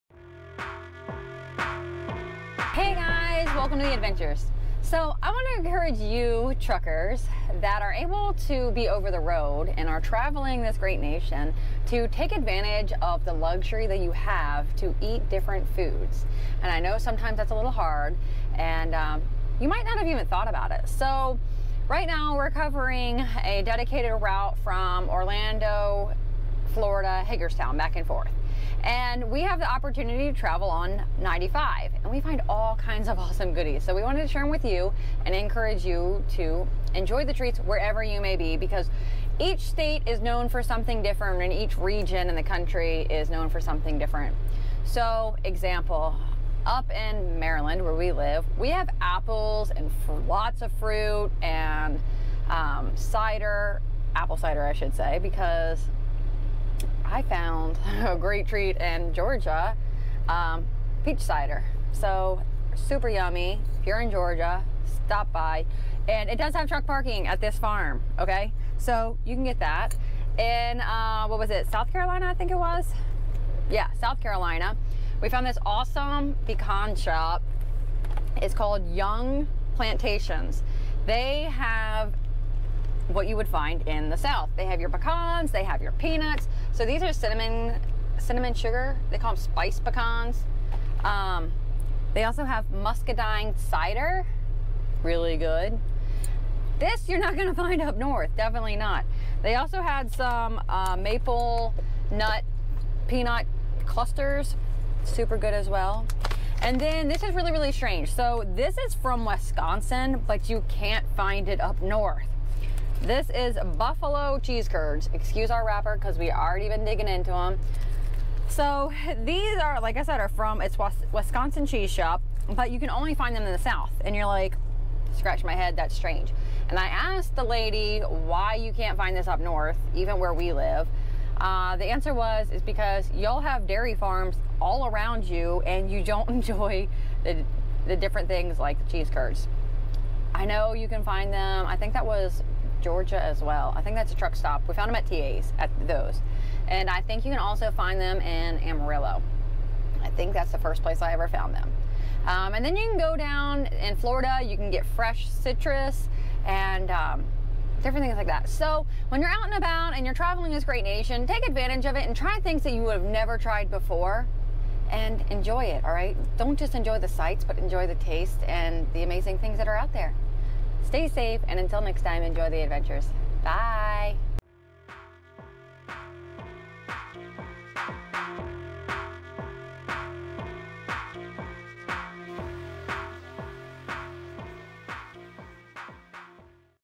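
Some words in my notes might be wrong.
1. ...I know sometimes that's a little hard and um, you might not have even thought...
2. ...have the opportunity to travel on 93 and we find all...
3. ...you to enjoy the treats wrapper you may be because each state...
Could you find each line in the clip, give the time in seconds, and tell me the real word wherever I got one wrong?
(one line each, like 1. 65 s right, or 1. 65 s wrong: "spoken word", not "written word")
1. 16 s right
2. 29 s wrong: "95", not "93"
3. 35 s wrong: "wherever", not "wrapper".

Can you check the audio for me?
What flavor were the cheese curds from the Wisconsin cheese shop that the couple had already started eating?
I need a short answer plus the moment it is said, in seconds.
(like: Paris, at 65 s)
Buffalo, at 113 s.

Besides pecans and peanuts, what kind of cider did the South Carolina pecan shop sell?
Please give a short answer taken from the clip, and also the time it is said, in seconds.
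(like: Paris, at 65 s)
Muscadine cider, at 92 s.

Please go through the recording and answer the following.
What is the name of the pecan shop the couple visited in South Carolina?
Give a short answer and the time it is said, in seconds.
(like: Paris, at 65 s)
Young Plantations, at 78 s.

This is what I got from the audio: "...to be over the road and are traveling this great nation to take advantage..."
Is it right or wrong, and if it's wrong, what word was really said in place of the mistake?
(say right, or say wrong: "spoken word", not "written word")
right.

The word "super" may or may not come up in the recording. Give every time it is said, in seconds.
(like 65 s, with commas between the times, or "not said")
62 s, 105 s.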